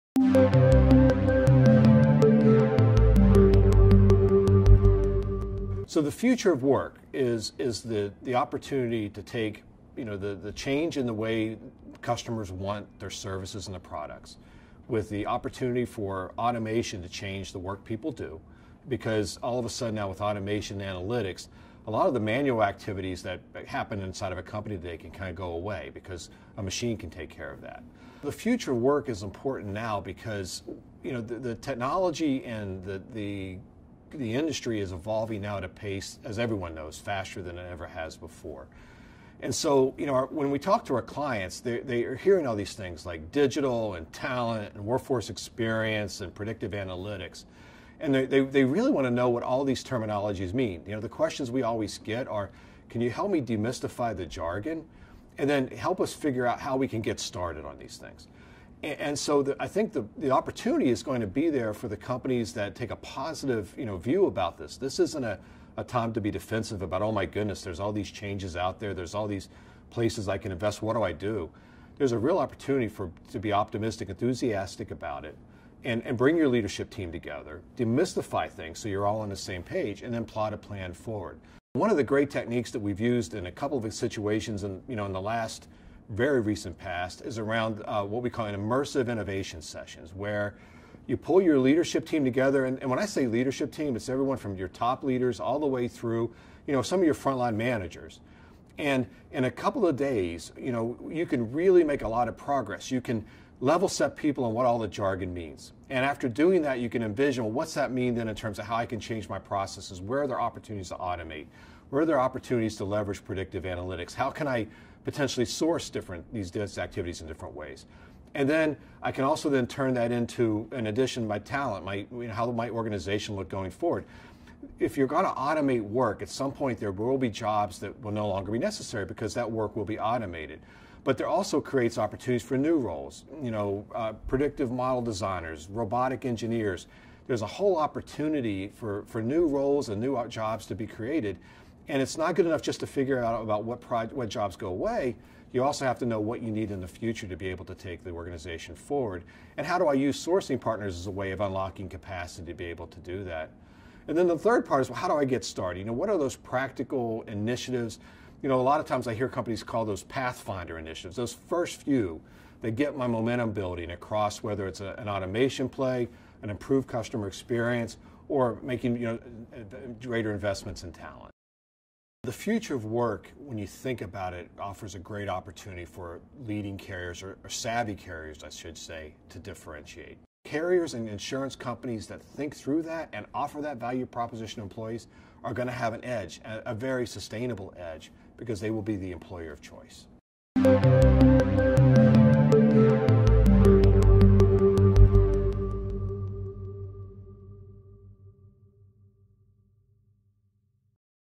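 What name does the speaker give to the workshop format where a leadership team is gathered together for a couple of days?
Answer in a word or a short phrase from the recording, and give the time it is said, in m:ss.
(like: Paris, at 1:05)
immersive innovation sessions, at 1:28.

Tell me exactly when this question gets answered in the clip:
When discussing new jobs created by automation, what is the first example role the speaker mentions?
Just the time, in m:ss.
2:14.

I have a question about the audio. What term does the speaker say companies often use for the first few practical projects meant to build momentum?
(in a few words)
pathfinder initiatives.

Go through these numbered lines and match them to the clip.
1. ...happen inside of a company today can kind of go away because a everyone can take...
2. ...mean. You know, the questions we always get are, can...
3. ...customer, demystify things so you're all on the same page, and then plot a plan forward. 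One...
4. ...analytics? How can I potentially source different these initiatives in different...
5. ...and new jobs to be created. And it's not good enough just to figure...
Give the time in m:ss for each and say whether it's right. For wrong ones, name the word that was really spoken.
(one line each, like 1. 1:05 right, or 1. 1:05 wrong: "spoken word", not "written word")
1. 0:23 wrong: "machine", not "everyone"
2. 0:50 right
3. 1:17 wrong: "together", not "customer"
4. 1:53 wrong: "activities", not "initiatives"
5. 2:19 right.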